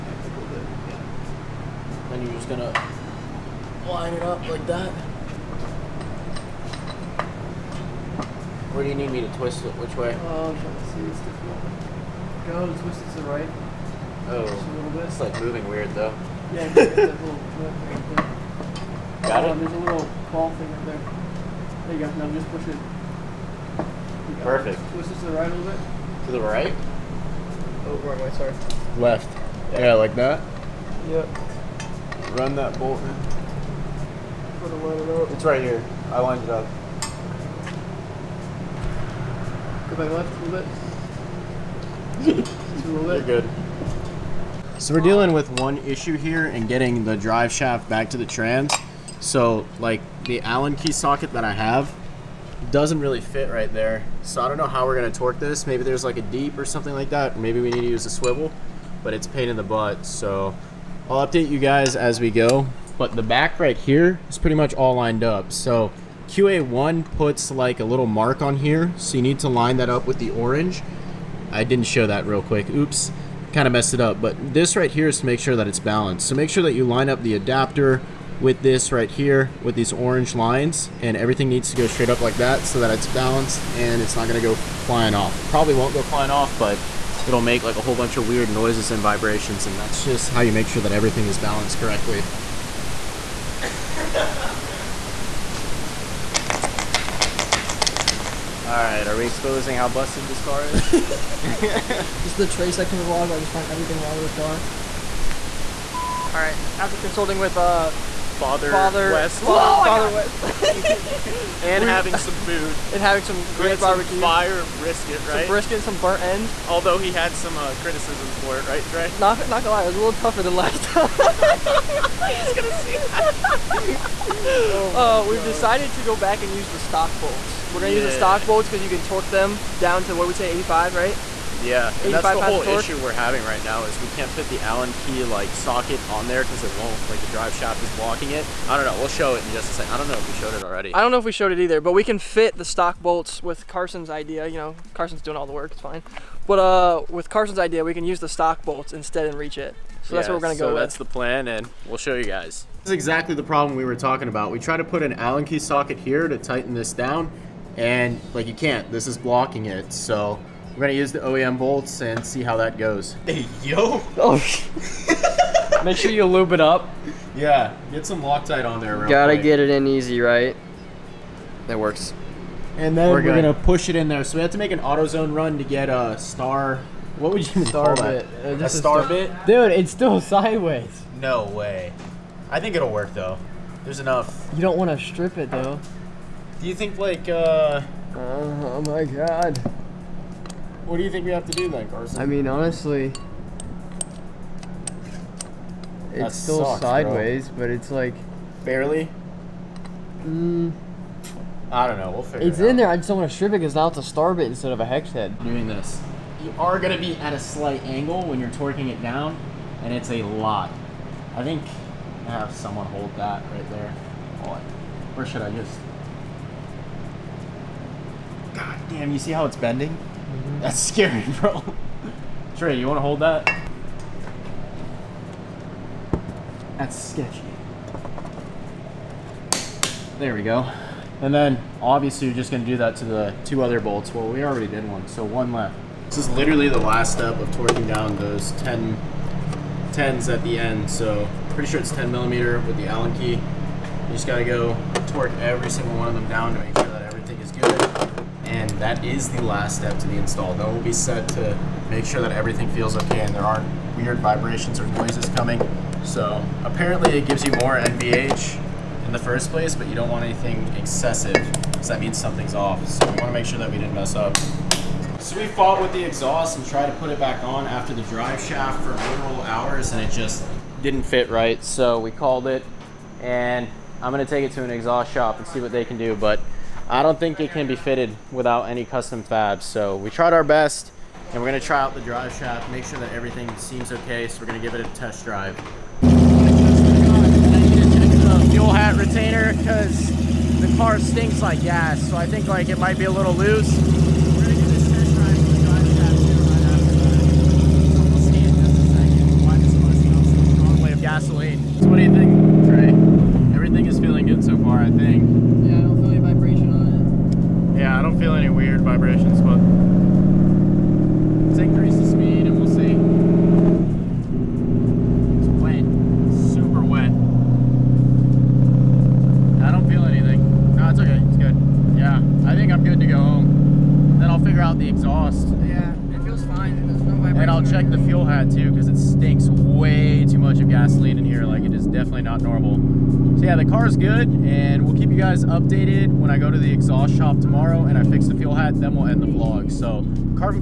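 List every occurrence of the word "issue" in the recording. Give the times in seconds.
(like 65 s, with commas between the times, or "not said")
45 s, 132 s.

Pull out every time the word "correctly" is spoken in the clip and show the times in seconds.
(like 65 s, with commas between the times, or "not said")
91 s.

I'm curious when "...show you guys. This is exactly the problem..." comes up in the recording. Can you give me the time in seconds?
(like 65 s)
151 s.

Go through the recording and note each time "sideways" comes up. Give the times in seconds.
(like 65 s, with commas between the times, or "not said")
180 s, 196 s.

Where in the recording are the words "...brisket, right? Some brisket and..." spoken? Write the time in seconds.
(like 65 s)
114 s.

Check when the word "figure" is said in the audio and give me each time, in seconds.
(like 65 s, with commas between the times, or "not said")
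202 s, 324 s.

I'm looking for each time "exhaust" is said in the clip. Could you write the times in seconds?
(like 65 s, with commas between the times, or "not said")
266 s, 274 s, 324 s, 336 s.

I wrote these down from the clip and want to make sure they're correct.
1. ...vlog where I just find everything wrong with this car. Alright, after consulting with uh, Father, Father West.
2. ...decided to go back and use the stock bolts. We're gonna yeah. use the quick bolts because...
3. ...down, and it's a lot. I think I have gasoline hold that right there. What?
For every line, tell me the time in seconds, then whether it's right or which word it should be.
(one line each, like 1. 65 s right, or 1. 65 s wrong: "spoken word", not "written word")
1. 103 s right
2. 125 s wrong: "stock", not "quick"
3. 209 s wrong: "someone", not "gasoline".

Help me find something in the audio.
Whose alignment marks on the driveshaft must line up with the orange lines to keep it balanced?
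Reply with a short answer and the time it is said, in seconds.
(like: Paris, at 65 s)
QA1, at 66 s.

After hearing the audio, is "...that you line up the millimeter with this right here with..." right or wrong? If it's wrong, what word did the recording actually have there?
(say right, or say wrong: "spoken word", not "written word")
wrong: "adapter", not "millimeter".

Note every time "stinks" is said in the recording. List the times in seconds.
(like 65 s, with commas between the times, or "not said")
290 s, 328 s.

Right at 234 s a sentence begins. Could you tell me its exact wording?
Well, we already did one, so one left.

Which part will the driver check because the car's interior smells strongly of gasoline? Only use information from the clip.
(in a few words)
Fuel hat retainer.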